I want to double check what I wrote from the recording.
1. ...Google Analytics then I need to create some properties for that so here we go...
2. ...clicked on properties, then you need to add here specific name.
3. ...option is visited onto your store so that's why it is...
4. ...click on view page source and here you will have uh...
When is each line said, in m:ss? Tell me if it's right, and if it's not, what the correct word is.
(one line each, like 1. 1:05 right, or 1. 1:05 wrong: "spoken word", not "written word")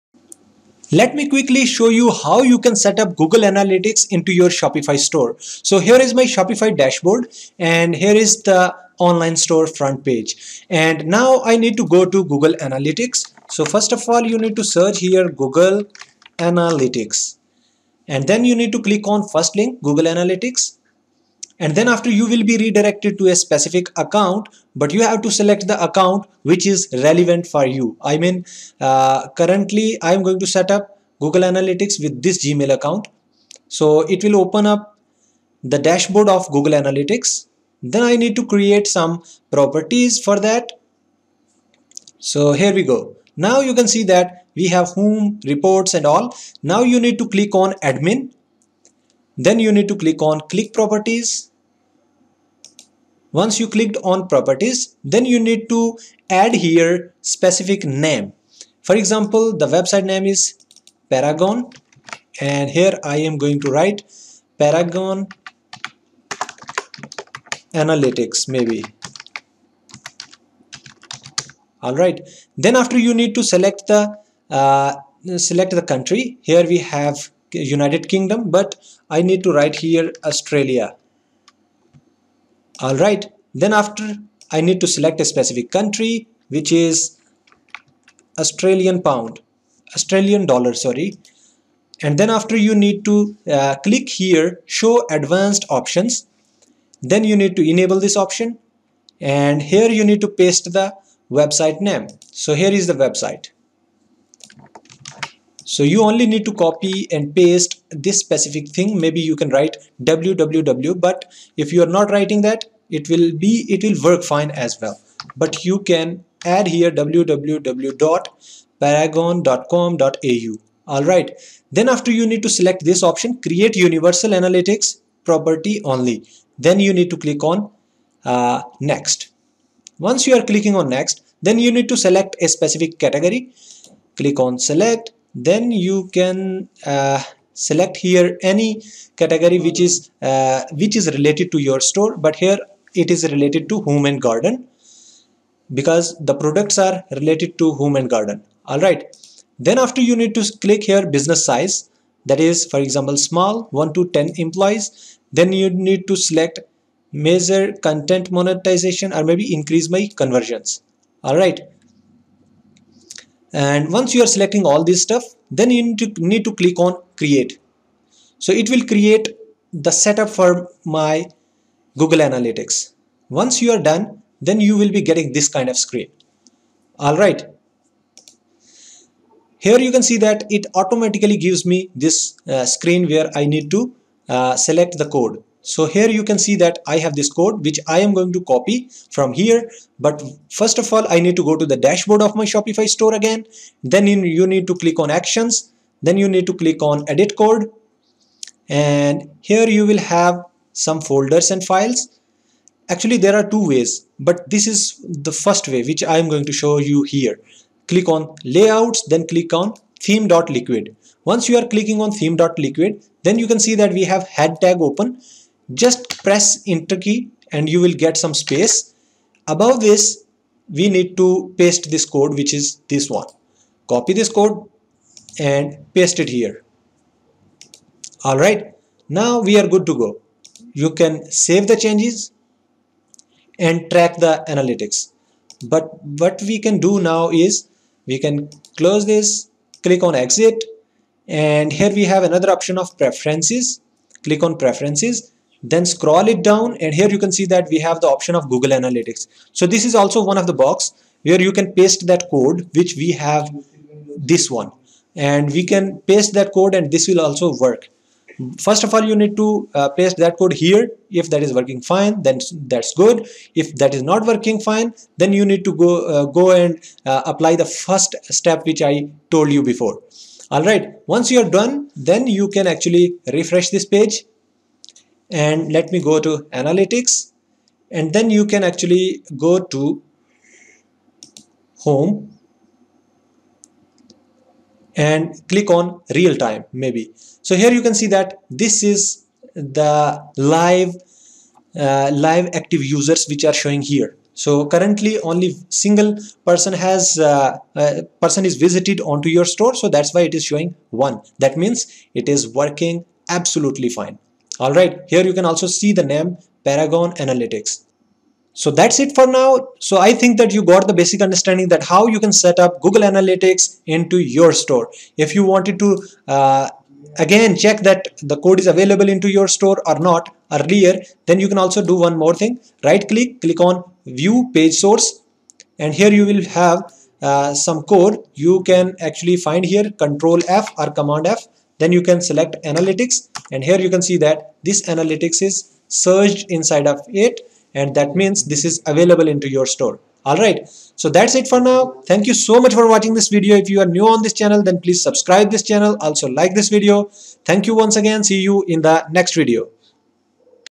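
1. 0:36 right
2. 0:53 right
3. 4:58 wrong: "person", not "option"
4. 5:23 right.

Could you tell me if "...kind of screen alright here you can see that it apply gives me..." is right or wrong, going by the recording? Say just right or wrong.
wrong.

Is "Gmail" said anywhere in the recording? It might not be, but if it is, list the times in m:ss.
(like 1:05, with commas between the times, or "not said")
0:32.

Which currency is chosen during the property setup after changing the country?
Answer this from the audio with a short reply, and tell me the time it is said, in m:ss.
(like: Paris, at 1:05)
Australian dollar, at 1:29.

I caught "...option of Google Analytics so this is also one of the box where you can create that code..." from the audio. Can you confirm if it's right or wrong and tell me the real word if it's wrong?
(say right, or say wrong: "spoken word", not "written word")
wrong: "paste", not "create".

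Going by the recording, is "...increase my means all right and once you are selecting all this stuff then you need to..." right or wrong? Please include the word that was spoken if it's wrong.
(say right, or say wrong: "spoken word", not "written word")
wrong: "conversions", not "means".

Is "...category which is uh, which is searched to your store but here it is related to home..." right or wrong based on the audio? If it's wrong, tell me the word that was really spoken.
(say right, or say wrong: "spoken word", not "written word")
wrong: "related", not "searched".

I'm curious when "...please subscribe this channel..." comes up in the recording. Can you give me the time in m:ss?
5:44.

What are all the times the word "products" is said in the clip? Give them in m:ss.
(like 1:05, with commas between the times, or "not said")
2:26.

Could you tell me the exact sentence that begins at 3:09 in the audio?
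But first of all, I need to go to the dashboard of my Shopify store again.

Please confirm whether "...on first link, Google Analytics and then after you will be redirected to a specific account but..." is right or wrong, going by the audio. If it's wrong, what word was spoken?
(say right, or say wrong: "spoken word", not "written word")
right.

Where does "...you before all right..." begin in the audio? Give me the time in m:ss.
4:29.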